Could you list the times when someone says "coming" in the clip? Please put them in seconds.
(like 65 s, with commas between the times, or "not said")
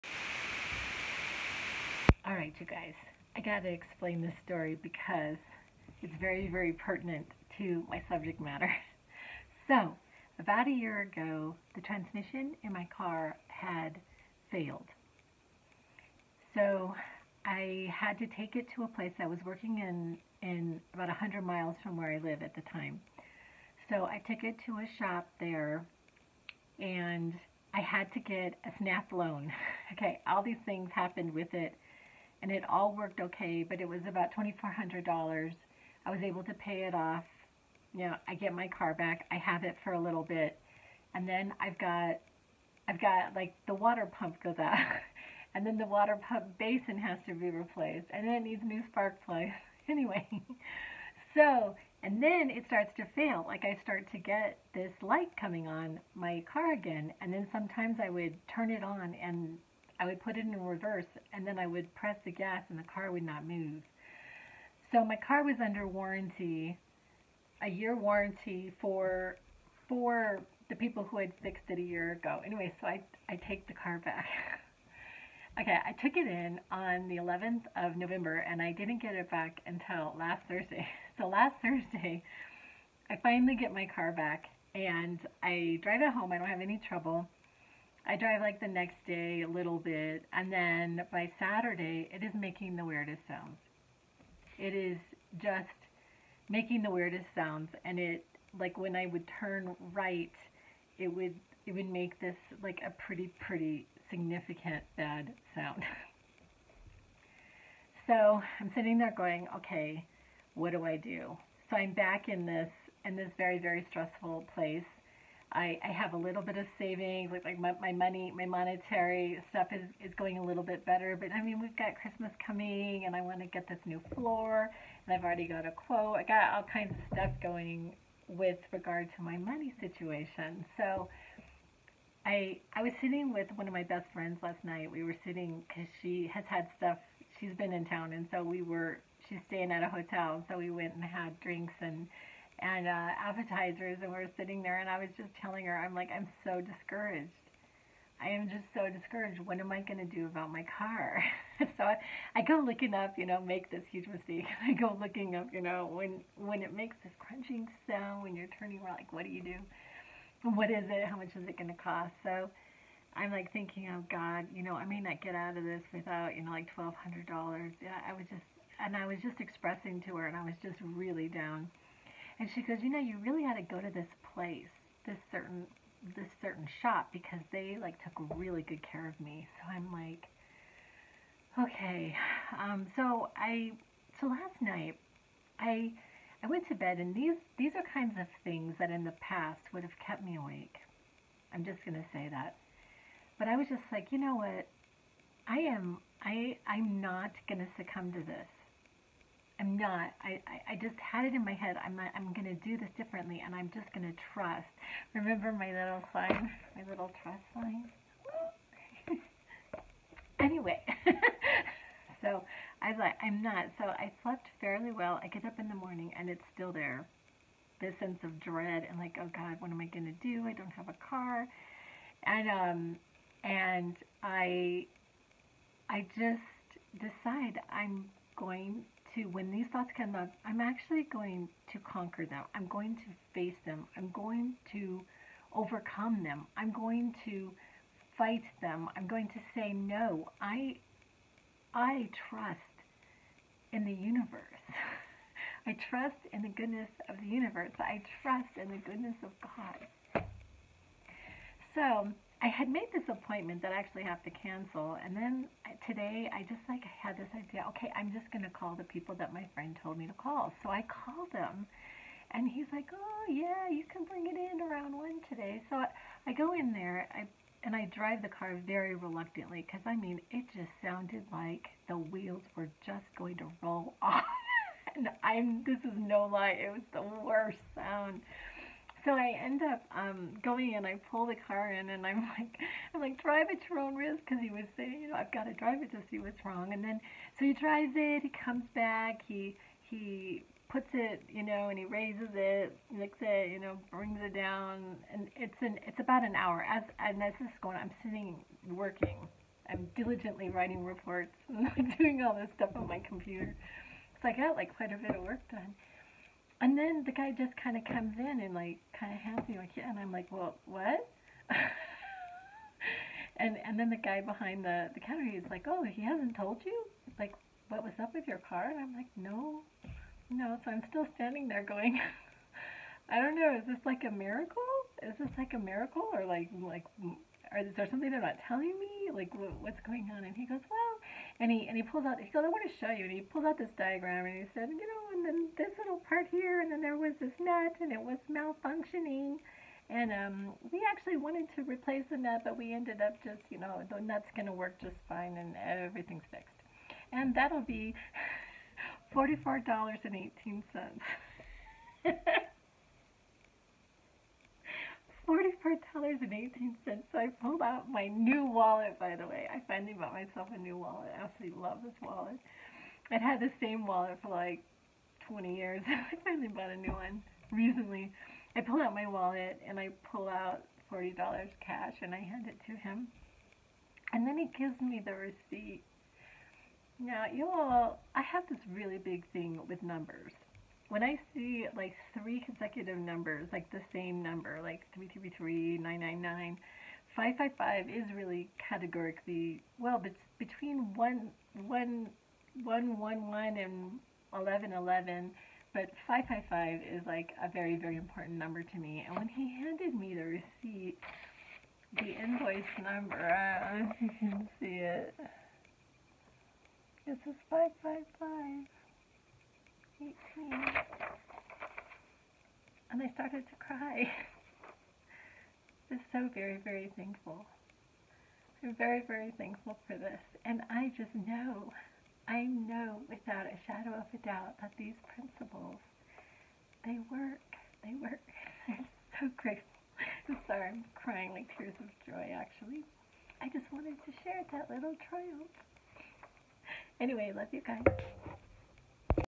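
55 s, 122 s.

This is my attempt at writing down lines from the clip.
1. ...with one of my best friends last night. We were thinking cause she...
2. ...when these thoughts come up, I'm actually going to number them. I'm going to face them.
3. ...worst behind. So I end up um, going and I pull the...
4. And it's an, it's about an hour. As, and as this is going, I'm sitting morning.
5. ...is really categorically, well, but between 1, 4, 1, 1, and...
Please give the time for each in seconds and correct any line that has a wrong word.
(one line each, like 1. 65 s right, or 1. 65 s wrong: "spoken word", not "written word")
1. 133 s wrong: "sitting", not "thinking"
2. 229 s wrong: "conquer", not "number"
3. 277 s wrong: "sound", not "behind"
4. 295 s wrong: "working", not "morning"
5. 387 s wrong: "1", not "4".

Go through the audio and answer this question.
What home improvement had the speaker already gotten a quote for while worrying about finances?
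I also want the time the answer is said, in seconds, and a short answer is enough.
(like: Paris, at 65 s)
new floor, at 123 s.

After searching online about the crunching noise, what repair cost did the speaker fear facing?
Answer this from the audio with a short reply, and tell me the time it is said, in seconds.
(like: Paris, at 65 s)
$1,200, at 166 s.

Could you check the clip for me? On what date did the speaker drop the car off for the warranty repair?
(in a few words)
11th of November.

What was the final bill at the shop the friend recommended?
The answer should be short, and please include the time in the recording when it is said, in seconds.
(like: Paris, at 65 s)
$44.18, at 349 s.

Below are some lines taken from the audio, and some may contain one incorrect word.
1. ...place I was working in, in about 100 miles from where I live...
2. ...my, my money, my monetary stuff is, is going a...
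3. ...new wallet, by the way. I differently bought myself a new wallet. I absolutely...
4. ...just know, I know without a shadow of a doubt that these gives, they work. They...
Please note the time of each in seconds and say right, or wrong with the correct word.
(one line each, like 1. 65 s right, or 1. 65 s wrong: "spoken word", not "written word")
1. 18 s right
2. 117 s right
3. 358 s wrong: "finally", not "differently"
4. 420 s wrong: "principles", not "gives".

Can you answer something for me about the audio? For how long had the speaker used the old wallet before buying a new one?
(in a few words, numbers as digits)
20 years.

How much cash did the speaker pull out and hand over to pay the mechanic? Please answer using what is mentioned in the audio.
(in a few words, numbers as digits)
$40.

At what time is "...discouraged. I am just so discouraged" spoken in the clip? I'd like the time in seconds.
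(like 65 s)
146 s.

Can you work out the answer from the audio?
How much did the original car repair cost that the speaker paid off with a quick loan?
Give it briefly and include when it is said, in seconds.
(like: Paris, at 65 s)
$2,400, at 34 s.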